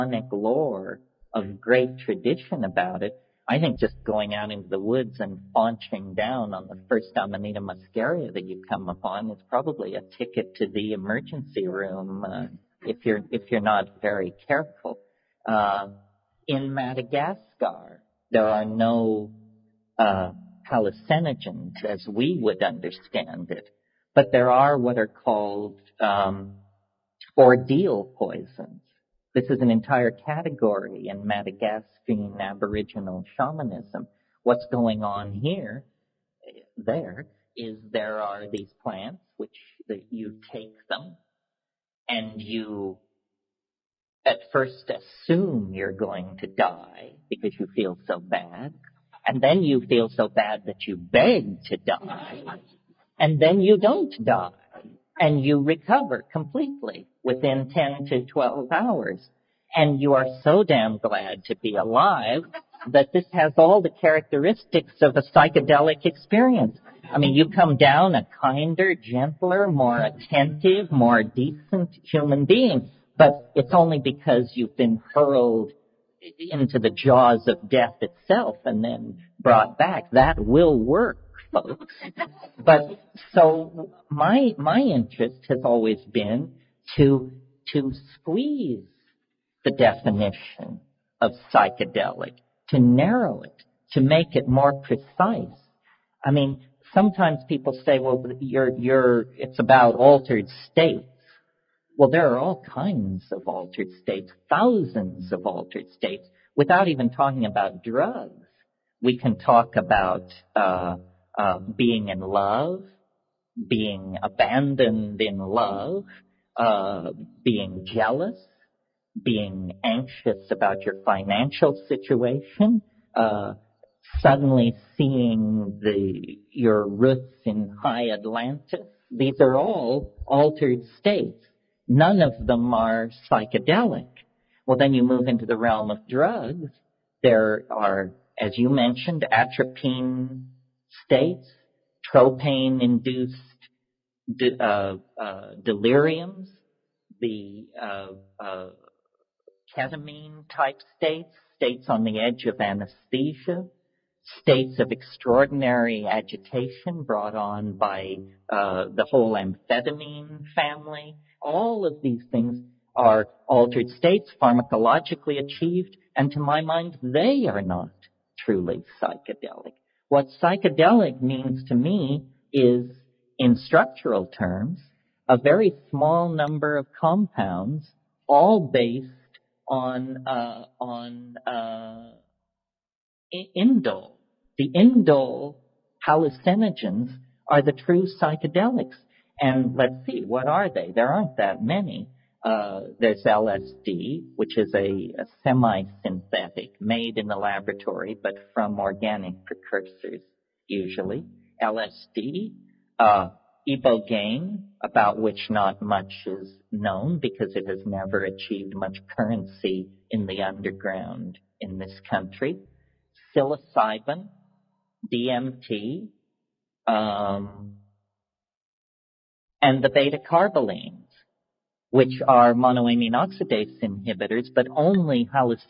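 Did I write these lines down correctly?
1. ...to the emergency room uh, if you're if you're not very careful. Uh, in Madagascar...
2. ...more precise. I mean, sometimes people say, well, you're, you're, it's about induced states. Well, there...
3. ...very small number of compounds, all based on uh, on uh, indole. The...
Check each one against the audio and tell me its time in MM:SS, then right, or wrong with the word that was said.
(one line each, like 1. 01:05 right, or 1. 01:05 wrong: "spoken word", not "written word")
1. 00:10 right
2. 01:34 wrong: "altered", not "induced"
3. 02:55 right.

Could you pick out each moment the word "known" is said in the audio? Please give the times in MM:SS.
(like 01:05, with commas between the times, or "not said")
03:26.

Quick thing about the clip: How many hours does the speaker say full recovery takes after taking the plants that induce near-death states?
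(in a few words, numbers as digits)
10 to 12.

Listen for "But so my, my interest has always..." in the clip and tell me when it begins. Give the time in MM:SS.
01:22.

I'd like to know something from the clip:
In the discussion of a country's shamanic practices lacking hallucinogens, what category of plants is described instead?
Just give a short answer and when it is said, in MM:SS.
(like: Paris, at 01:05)
Ordeal poisons, at 00:27.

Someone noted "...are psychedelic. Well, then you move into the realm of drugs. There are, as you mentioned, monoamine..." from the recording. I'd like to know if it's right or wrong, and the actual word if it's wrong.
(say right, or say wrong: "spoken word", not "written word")
wrong: "atropine", not "monoamine".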